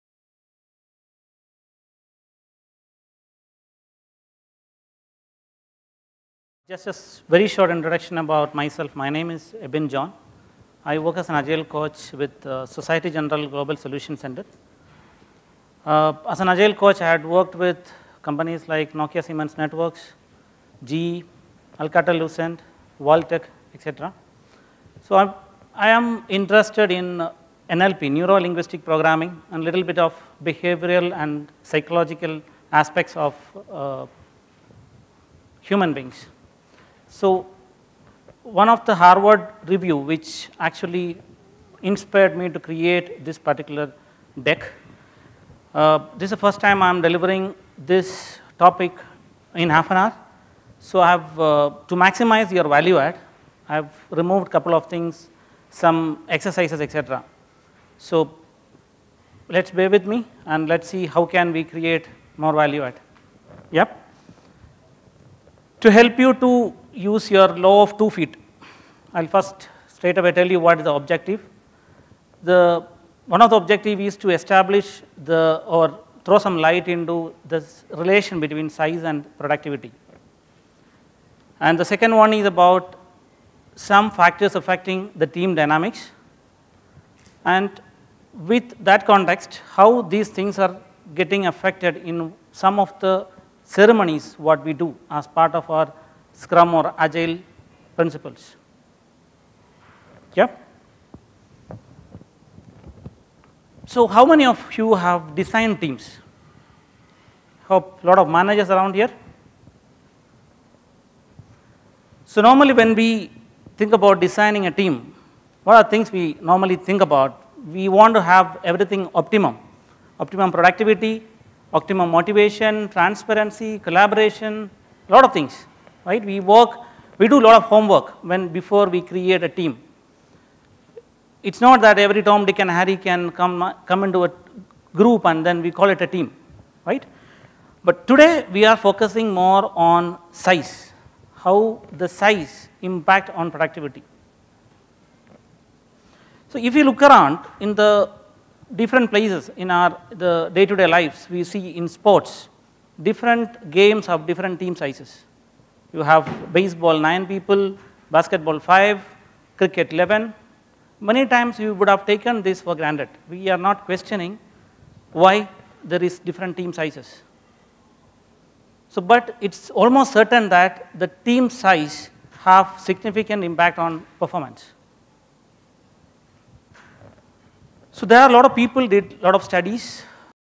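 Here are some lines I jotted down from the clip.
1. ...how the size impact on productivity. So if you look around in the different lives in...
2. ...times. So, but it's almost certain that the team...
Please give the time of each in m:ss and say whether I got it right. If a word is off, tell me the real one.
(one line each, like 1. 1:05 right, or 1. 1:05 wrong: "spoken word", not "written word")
1. 2:21 wrong: "places", not "lives"
2. 2:46 wrong: "sizes", not "times".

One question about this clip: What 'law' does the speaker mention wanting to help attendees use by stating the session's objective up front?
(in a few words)
Law of 2 feet.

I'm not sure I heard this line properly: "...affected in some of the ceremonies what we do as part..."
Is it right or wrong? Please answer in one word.
right.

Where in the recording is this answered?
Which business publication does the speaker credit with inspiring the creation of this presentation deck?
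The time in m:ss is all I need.
0:38.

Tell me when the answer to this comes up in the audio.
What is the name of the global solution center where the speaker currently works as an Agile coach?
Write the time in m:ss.
0:12.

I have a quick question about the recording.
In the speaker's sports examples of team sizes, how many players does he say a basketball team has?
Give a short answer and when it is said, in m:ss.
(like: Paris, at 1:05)
5, at 2:38.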